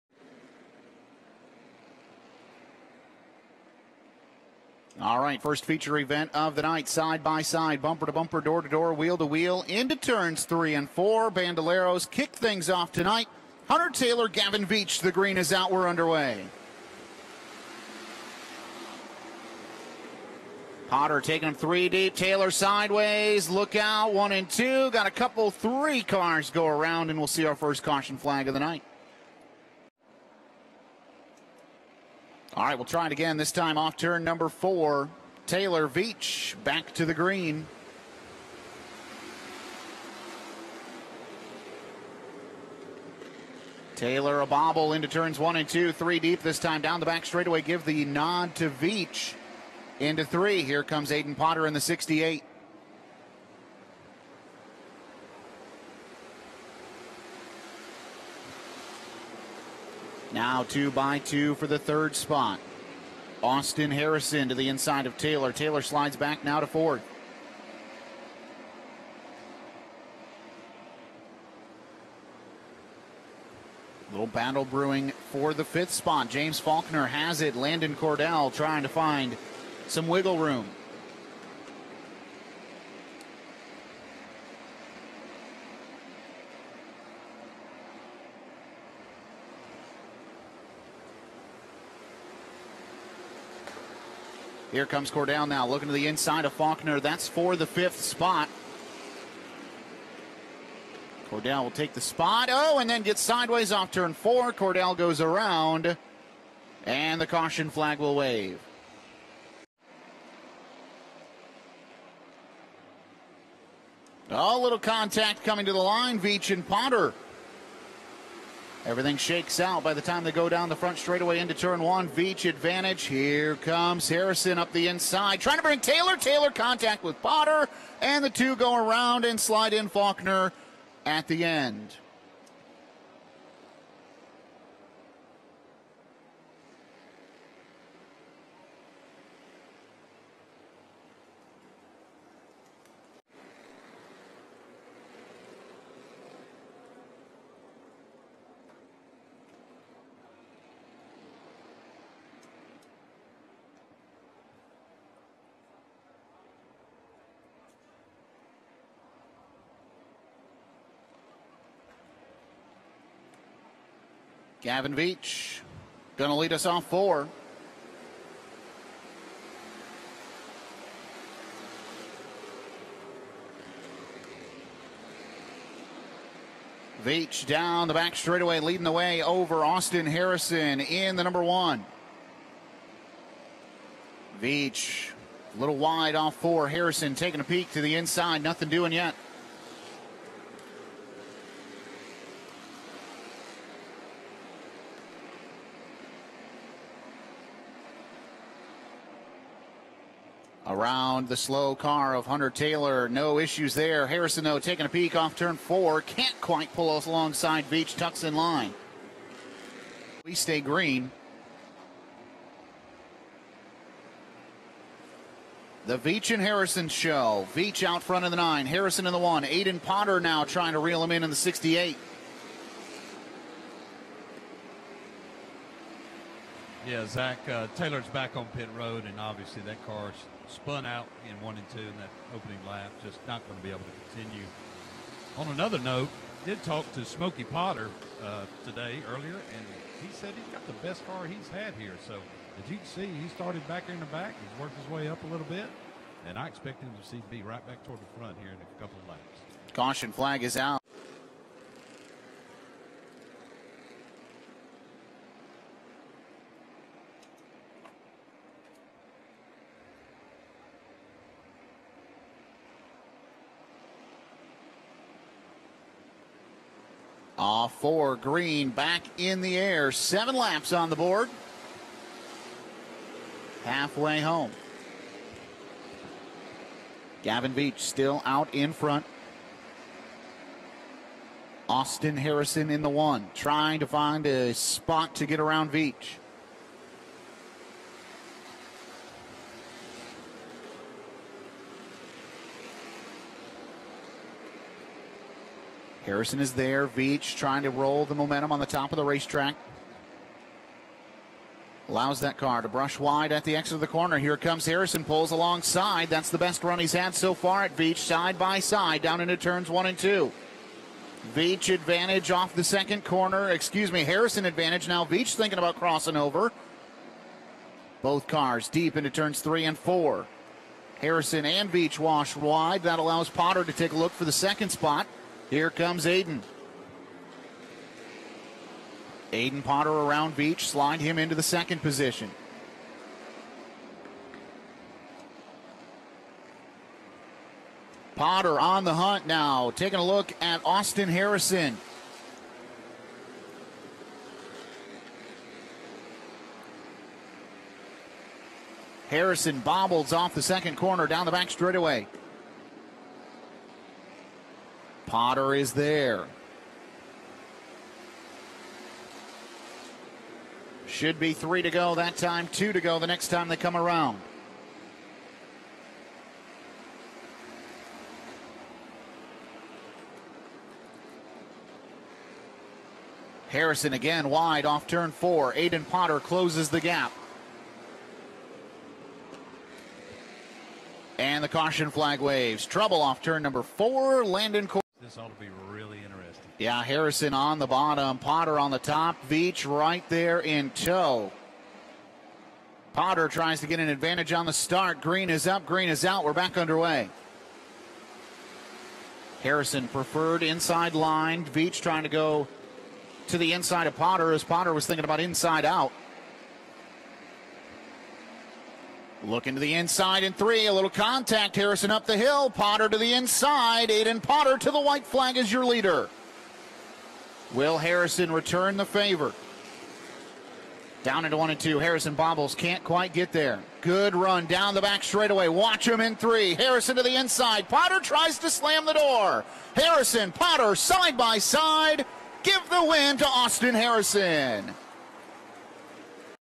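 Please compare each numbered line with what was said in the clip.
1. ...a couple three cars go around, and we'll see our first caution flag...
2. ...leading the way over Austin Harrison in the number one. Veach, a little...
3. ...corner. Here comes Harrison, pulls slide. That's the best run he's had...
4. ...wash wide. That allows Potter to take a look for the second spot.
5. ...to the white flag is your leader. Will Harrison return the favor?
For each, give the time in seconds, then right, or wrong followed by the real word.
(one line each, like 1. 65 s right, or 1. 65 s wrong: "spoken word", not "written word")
1. 25 s right
2. 178 s right
3. 303 s wrong: "alongside", not "slide"
4. 321 s right
5. 414 s right.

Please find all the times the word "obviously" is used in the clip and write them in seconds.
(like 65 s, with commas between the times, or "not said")
229 s.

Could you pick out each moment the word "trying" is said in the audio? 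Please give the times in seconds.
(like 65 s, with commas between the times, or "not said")
78 s, 125 s, 220 s, 283 s, 297 s, 401 s.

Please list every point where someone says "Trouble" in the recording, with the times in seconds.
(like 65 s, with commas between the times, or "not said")
382 s.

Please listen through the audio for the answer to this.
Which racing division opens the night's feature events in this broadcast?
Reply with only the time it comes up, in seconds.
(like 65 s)
11 s.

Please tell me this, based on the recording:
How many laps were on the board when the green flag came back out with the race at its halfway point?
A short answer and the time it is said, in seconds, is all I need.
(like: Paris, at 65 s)
7, at 269 s.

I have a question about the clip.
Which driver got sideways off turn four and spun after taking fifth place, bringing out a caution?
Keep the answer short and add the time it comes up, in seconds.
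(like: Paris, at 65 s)
Landon Cordell, at 104 s.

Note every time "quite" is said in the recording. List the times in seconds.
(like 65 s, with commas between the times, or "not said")
206 s, 422 s.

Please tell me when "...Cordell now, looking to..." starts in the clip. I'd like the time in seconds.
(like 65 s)
95 s.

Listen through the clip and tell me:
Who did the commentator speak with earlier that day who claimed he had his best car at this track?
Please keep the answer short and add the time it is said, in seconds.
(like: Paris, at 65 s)
Smokey Potter, at 237 s.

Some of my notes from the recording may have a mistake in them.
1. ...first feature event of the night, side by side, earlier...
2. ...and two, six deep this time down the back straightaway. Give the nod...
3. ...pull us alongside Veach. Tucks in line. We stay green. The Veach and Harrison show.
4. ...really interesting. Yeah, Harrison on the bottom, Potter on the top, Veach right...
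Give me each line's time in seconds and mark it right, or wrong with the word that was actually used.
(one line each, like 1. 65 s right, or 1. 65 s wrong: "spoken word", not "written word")
1. 5 s wrong: "bumper", not "earlier"
2. 45 s wrong: "three", not "six"
3. 206 s right
4. 385 s right.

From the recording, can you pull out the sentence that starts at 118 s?
Everything shakes out by the time they go down the front straightaway into turn one.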